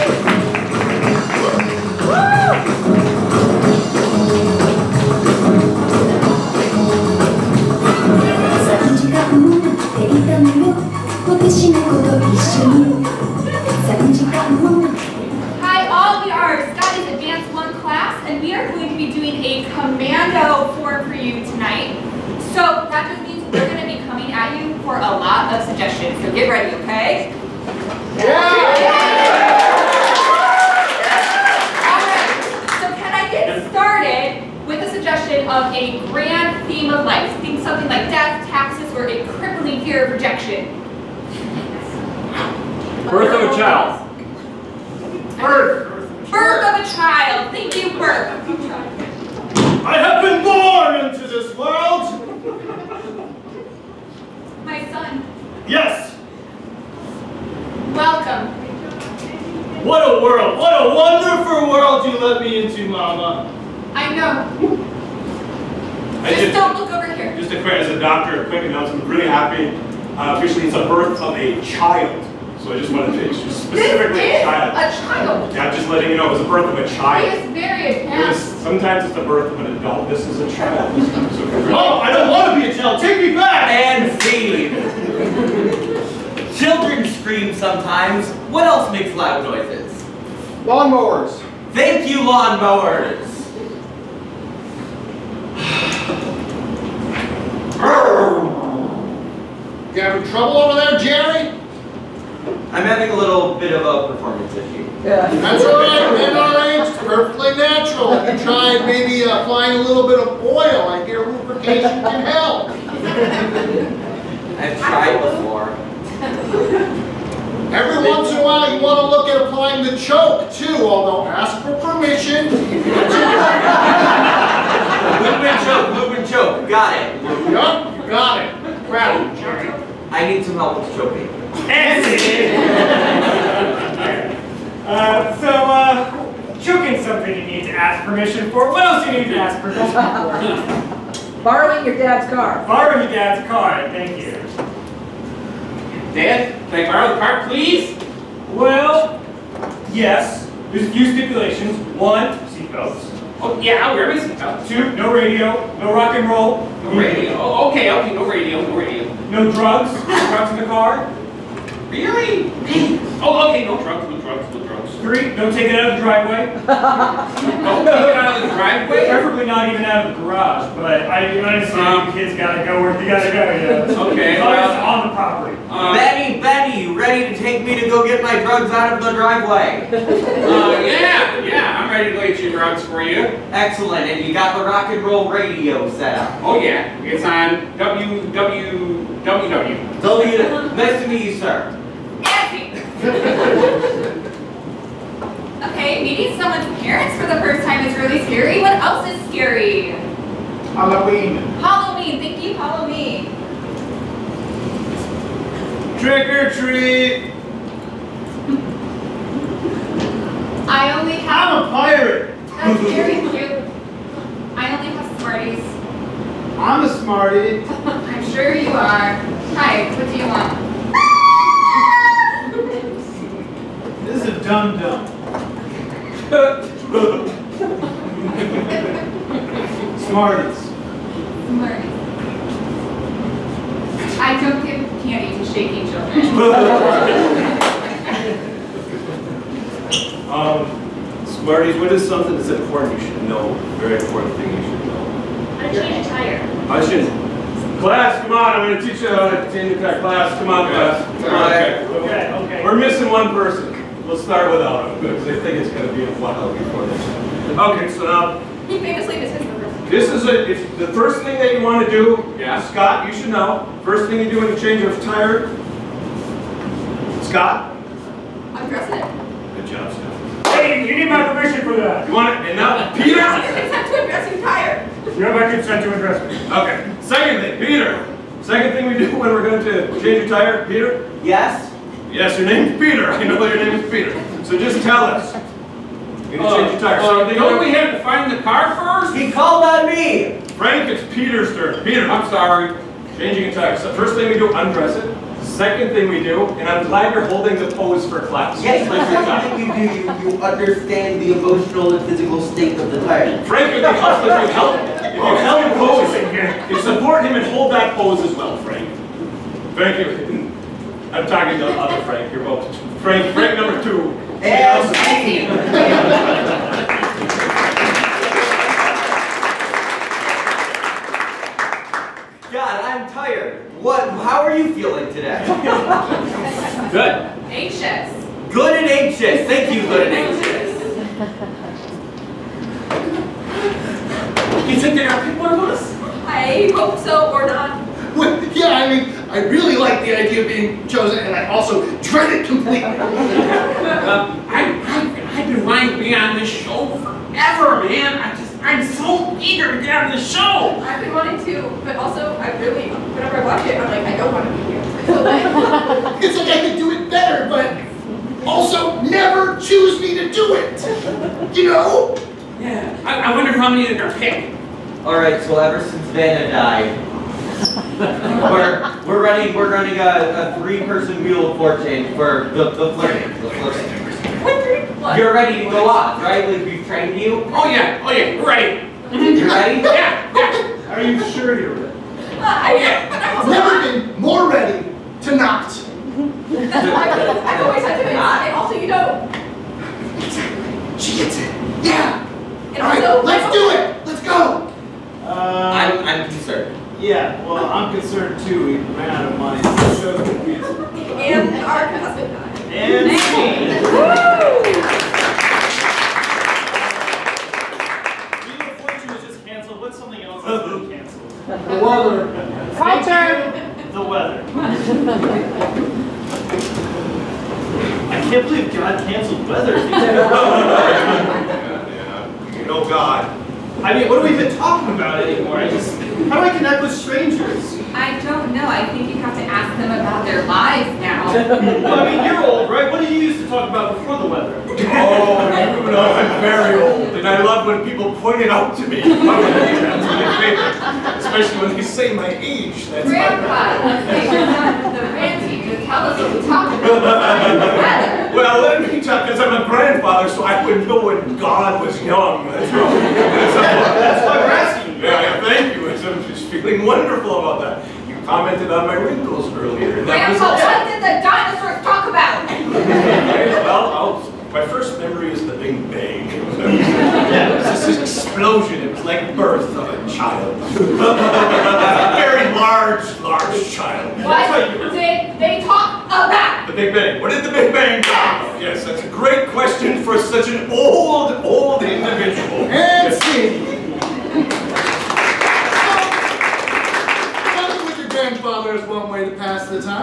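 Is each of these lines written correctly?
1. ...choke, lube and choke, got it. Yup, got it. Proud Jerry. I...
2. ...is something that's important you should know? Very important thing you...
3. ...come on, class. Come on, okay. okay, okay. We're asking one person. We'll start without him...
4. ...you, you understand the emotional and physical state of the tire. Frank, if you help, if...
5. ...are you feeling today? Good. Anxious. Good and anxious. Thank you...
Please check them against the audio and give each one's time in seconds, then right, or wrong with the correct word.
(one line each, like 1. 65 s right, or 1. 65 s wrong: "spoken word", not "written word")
1. 125 s right
2. 241 s right
3. 250 s wrong: "missing", not "asking"
4. 300 s right
5. 324 s right.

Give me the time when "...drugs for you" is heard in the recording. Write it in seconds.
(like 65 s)
182 s.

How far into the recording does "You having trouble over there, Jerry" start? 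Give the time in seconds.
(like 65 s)
99 s.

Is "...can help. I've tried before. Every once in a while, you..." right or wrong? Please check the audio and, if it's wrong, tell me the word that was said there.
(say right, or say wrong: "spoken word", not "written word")
right.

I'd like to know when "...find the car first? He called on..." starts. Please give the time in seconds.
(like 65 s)
288 s.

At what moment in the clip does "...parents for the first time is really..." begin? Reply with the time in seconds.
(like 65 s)
196 s.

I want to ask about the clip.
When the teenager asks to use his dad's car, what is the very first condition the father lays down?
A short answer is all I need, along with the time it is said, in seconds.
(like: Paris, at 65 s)
Seatbelts, at 152 s.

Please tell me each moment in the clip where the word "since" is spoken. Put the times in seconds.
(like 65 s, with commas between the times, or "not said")
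365 s.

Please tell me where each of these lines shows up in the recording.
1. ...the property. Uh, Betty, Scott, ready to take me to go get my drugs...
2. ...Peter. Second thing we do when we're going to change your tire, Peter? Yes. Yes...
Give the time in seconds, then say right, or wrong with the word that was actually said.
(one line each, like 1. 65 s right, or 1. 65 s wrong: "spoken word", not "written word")
1. 175 s wrong: "Betty", not "Scott"
2. 277 s right.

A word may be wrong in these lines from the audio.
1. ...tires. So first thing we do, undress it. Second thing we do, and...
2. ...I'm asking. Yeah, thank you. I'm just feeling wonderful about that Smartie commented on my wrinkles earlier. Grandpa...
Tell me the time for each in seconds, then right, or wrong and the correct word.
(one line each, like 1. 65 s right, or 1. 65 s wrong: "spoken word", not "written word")
1. 293 s right
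2. 454 s wrong: "You", not "Smartie".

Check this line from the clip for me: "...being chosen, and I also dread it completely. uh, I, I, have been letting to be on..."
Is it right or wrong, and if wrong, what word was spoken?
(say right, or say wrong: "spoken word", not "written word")
wrong: "wanting", not "letting".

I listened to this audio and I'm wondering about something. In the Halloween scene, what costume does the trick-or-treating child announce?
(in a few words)
A pirate.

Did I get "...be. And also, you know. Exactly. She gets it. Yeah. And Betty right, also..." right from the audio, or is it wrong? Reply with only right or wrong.
wrong.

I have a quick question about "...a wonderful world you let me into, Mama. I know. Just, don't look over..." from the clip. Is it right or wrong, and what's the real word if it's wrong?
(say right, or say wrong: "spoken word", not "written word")
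right.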